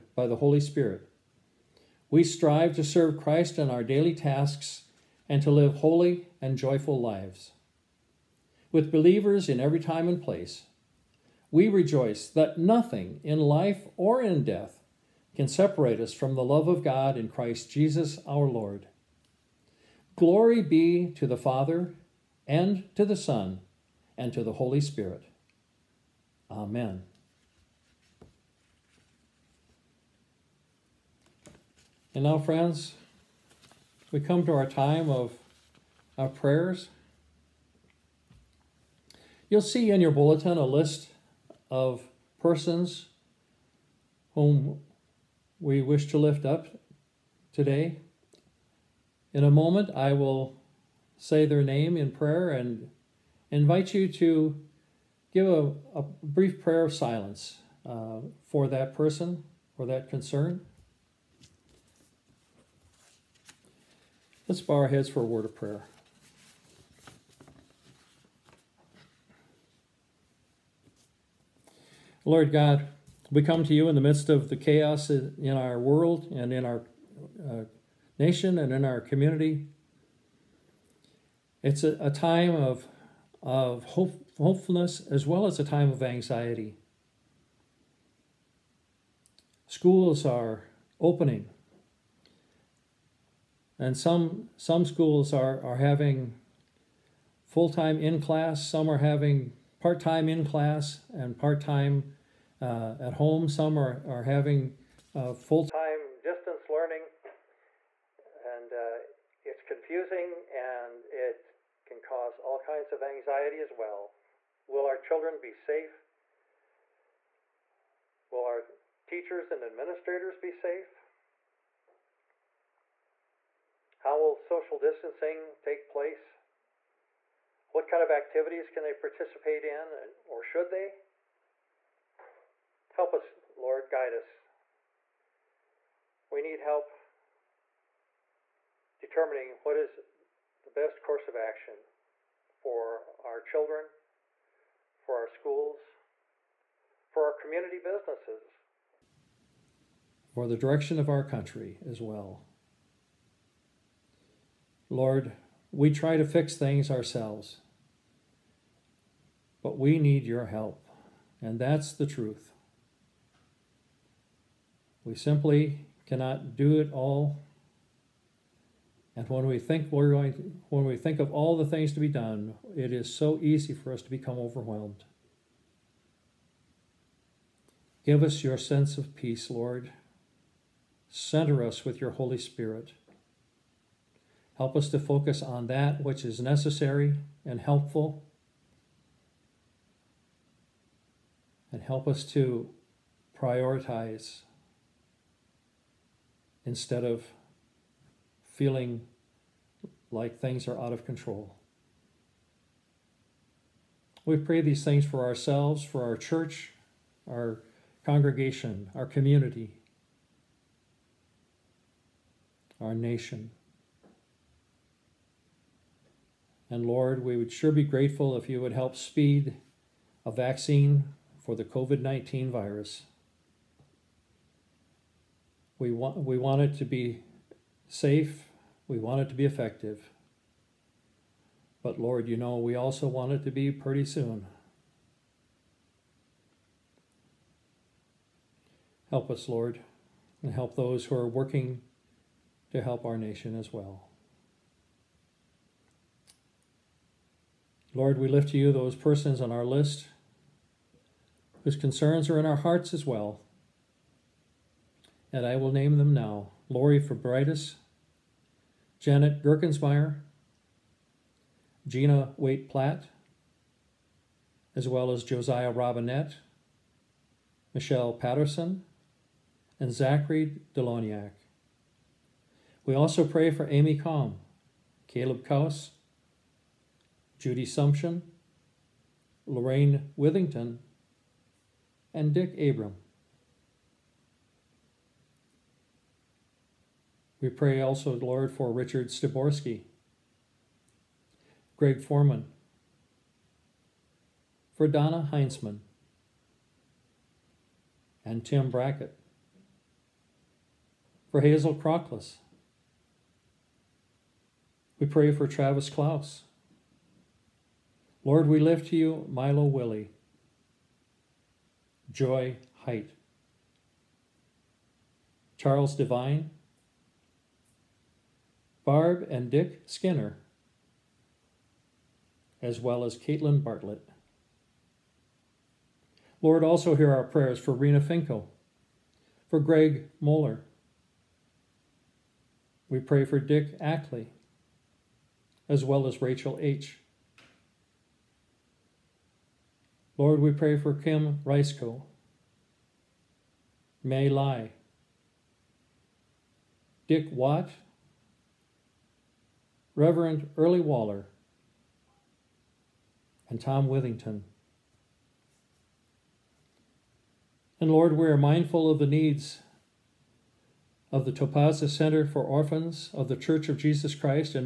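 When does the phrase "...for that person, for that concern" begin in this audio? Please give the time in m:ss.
0:58.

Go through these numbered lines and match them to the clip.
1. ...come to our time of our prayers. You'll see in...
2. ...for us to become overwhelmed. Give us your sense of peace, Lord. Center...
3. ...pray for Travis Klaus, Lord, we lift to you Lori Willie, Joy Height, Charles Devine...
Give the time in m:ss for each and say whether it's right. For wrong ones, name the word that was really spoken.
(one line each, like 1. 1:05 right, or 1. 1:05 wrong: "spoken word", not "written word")
1. 0:34 right
2. 2:53 right
3. 5:05 wrong: "Milo", not "Lori".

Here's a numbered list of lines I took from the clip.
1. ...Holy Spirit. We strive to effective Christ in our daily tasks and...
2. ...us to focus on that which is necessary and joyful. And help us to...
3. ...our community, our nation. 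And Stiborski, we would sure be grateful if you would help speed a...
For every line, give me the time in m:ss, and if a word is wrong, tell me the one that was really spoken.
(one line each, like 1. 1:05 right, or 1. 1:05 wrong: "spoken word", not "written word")
1. 0:00 wrong: "serve", not "effective"
2. 3:04 wrong: "helpful", not "joyful"
3. 3:28 wrong: "Lord", not "Stiborski".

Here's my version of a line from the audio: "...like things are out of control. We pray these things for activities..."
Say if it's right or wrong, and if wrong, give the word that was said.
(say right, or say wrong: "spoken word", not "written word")
wrong: "ourselves", not "activities".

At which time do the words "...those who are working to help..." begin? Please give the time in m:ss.
4:00.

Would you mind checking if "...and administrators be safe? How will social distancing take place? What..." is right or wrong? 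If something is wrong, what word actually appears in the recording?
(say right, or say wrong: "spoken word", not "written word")
right.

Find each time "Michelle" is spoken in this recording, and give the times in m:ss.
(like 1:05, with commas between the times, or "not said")
4:27.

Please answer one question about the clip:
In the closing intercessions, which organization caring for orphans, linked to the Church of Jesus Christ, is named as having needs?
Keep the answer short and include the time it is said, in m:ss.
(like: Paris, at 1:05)
Topaza Center, at 6:01.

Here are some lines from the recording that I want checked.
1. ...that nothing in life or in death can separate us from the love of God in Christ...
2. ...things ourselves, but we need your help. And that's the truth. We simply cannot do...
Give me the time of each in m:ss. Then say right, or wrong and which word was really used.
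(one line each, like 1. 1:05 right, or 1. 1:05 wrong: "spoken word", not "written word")
1. 0:12 right
2. 2:36 right.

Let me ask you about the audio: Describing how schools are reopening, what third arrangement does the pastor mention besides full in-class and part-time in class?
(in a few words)
full-time distance learning.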